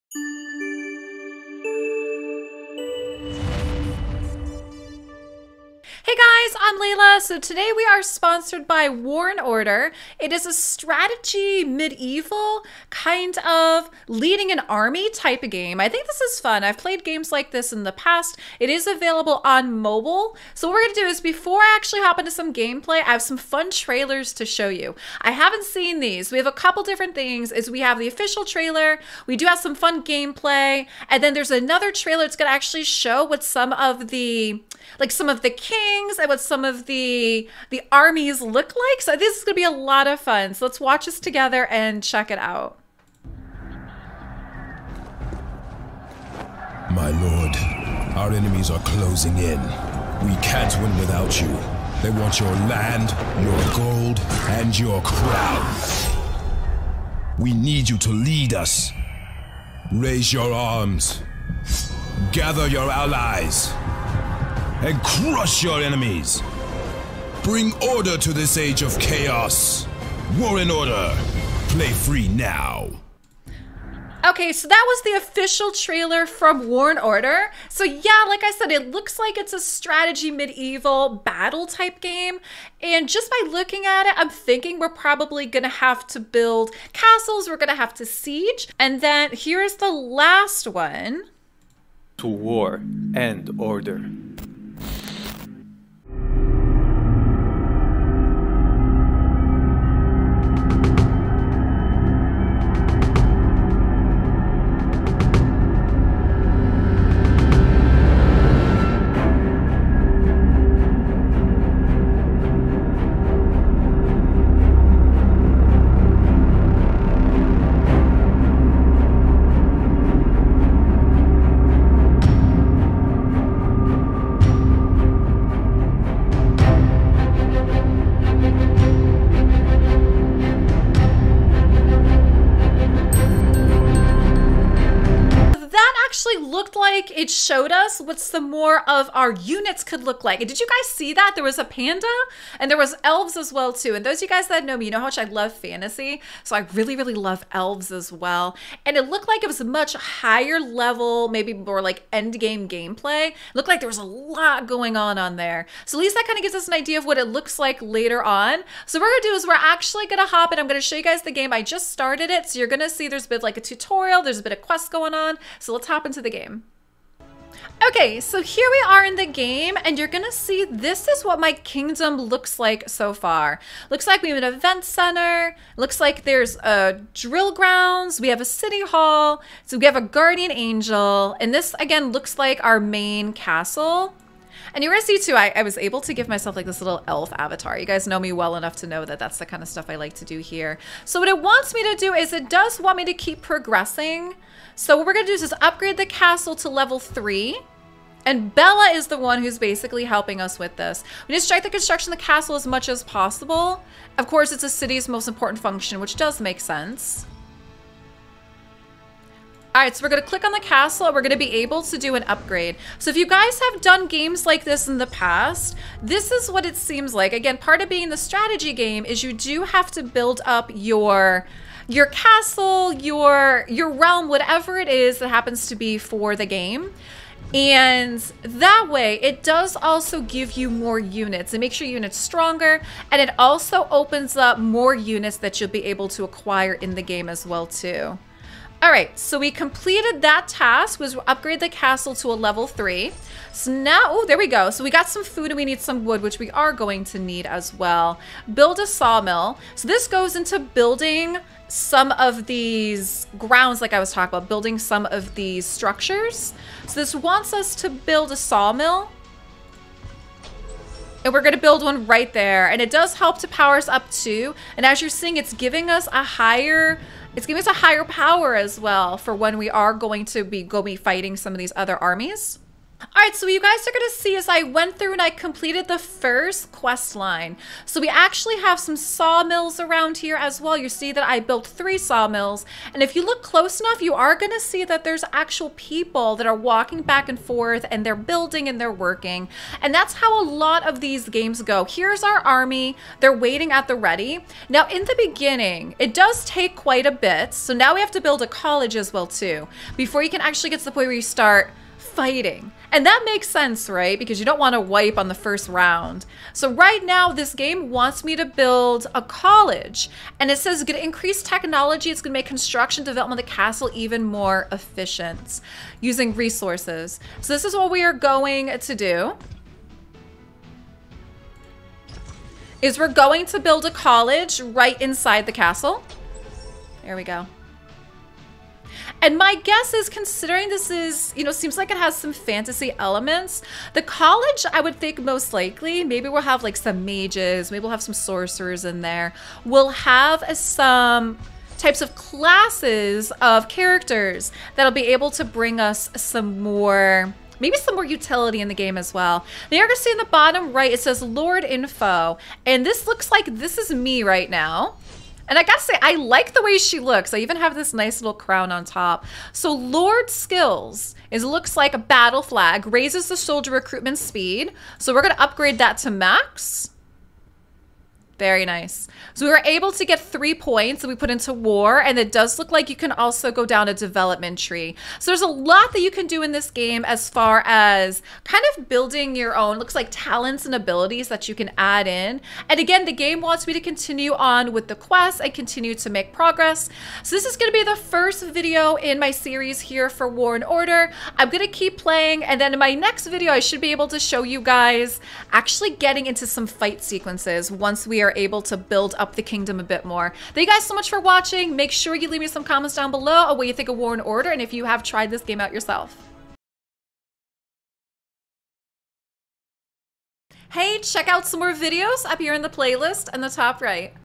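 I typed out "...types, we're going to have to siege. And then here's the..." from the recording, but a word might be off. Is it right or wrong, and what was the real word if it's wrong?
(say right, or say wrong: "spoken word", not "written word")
wrong: "castles", not "types".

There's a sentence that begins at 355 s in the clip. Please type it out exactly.
And I gotta say, I like the way she looks.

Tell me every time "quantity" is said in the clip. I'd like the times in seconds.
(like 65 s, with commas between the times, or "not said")
not said.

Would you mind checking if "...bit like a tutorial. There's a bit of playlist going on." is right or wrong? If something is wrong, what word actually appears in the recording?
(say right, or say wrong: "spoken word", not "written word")
wrong: "quest", not "playlist".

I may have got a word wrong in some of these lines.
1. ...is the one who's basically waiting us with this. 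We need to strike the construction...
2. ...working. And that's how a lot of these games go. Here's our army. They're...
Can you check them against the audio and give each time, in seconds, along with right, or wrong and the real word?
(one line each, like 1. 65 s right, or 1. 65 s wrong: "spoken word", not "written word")
1. 198 s wrong: "helping", not "waiting"
2. 288 s right.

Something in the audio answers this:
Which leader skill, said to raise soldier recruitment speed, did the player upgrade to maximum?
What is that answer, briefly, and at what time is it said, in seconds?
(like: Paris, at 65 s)
Battle flag, at 361 s.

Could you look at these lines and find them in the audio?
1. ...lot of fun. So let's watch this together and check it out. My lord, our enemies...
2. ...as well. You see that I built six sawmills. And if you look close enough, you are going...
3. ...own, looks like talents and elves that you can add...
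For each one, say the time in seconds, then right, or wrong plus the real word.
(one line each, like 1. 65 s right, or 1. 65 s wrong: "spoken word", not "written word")
1. 39 s right
2. 280 s wrong: "three", not "six"
3. 379 s wrong: "abilities", not "elves".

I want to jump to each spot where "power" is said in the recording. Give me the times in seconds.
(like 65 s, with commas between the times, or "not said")
263 s, 268 s.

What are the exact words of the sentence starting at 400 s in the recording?
Thank you guys so much for watching.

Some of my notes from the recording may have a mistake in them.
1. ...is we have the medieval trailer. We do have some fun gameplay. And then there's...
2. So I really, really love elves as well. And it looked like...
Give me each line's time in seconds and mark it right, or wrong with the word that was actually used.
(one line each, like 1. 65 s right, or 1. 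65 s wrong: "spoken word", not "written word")
1. 27 s wrong: "official", not "medieval"
2. 146 s right.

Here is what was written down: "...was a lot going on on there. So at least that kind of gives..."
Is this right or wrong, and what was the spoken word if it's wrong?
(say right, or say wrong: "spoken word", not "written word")
right.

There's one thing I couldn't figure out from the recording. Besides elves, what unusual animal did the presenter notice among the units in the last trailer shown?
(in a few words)
panda.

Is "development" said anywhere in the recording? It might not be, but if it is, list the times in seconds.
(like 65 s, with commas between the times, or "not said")
313 s, 373 s.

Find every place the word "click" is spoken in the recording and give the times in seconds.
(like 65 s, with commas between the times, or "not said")
210 s.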